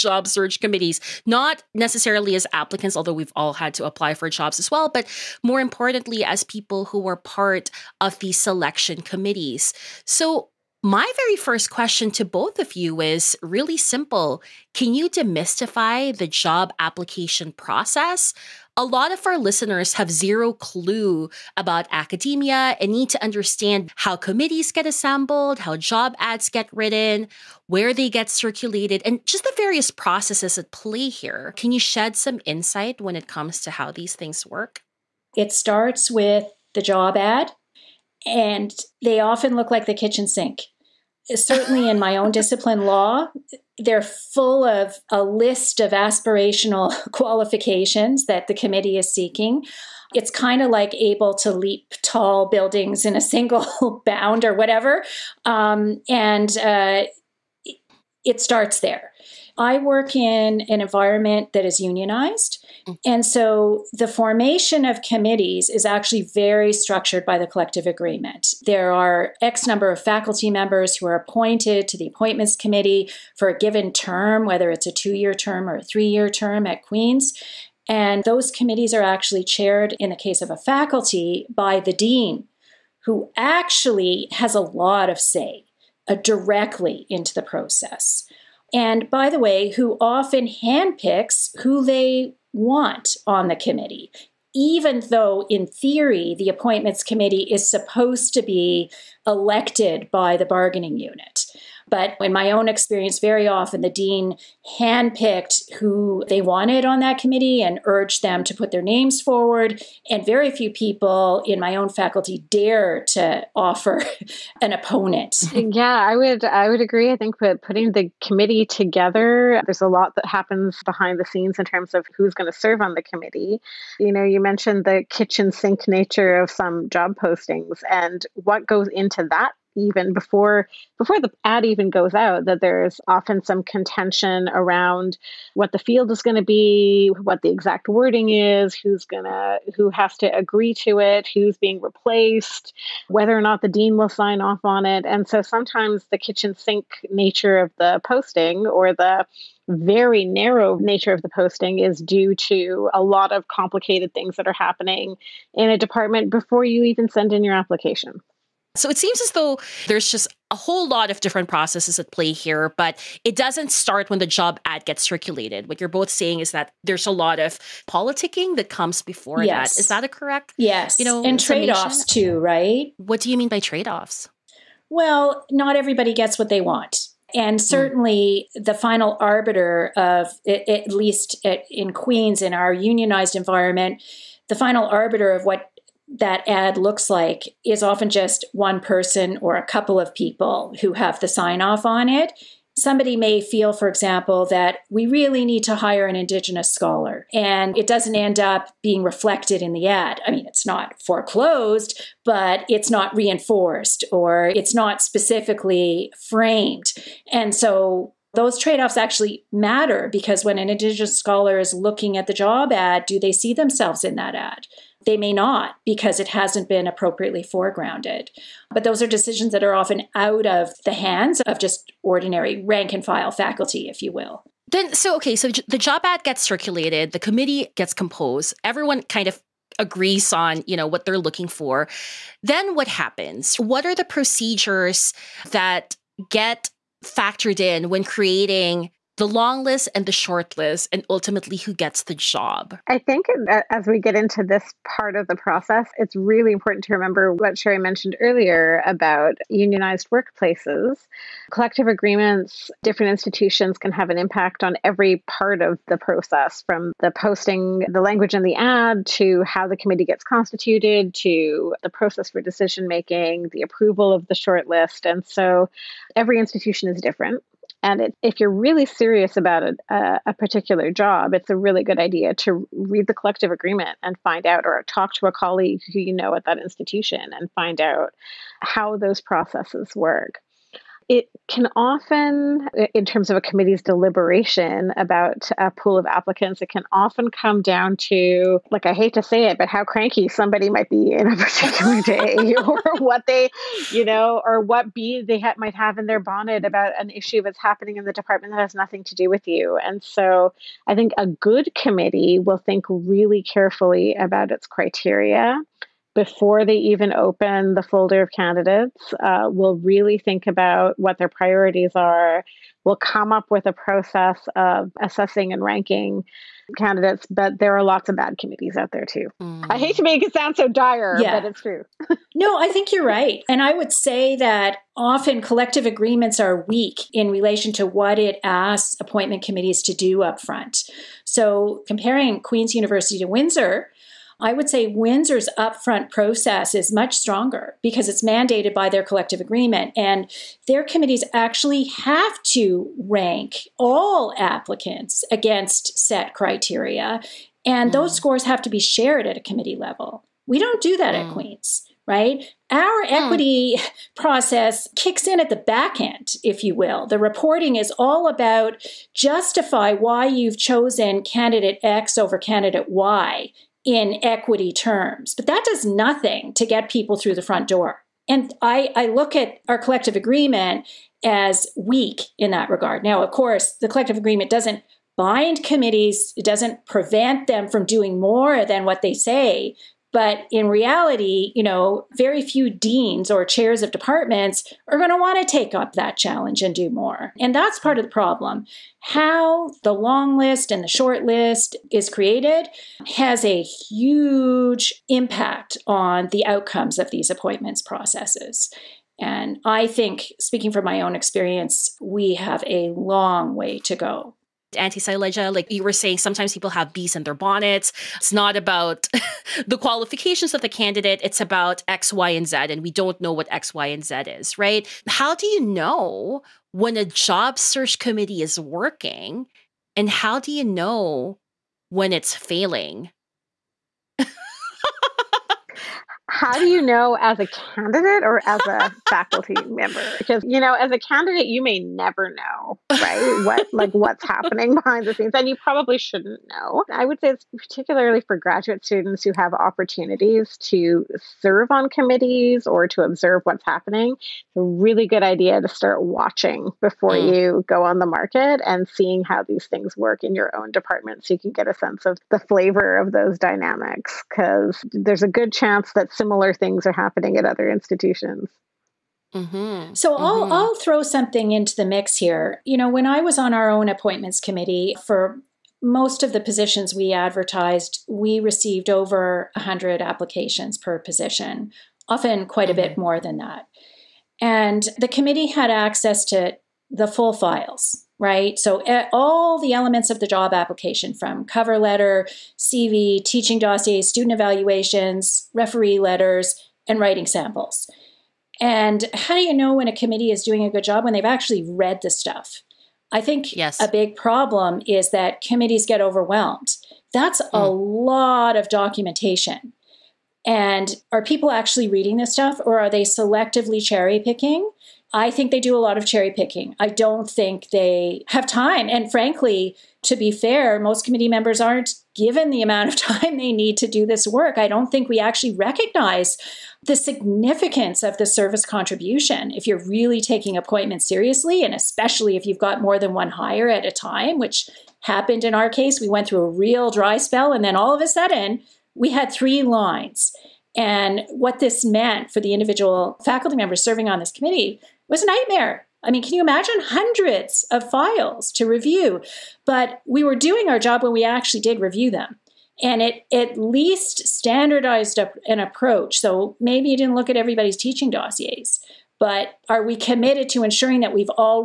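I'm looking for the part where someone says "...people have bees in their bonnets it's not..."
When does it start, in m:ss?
6:46.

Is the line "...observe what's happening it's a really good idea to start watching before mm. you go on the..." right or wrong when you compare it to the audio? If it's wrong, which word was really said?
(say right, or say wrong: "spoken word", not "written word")
right.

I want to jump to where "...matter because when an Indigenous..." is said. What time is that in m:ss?
3:29.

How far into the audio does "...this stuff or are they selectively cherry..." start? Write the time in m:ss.
8:22.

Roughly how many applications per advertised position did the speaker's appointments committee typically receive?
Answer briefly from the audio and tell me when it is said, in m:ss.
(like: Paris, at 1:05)
Over 100, at 7:48.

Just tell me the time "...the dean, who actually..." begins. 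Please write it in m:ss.
1:21.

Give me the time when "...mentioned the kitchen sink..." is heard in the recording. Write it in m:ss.
2:04.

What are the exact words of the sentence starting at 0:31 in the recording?
Can you shed some insight when it comes to how these things work?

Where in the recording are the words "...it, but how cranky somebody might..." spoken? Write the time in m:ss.
4:49.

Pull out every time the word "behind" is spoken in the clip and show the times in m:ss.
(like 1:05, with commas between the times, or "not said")
2:00, 7:14.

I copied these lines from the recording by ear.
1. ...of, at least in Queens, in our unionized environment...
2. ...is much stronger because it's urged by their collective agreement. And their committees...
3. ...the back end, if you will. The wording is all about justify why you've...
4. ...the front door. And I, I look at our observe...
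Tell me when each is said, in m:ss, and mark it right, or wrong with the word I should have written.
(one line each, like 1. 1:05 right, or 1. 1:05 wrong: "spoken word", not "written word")
1. 2:59 right
2. 5:36 wrong: "mandated", not "urged"
3. 5:55 wrong: "reporting", not "wording"
4. 6:07 wrong: "collective", not "observe".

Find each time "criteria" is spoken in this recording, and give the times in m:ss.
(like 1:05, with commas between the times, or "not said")
5:04, 5:46.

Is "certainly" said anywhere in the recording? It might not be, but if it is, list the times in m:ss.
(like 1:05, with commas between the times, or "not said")
0:41, 2:57.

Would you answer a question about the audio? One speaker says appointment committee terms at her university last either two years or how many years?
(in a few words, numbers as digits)
3 years.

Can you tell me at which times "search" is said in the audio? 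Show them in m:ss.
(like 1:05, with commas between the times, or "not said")
0:00, 6:57.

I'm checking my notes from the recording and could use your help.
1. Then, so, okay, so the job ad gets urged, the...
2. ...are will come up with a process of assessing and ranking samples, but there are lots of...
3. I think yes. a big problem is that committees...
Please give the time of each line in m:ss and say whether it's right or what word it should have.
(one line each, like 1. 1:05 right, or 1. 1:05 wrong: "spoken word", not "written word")
1. 3:44 wrong: "circulated", not "urged"
2. 5:11 wrong: "candidates", not "samples"
3. 8:13 right.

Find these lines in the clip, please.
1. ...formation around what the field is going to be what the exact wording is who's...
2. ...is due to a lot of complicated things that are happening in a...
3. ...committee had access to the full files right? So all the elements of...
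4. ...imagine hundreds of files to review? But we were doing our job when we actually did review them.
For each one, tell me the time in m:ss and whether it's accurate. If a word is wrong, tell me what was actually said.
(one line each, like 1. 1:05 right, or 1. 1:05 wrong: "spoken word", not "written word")
1. 2:13 wrong: "contention", not "formation"
2. 2:31 right
3. 7:55 right
4. 8:56 right.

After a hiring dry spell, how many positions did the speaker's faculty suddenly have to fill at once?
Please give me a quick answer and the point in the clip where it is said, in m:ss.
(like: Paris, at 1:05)
3, at 8:49.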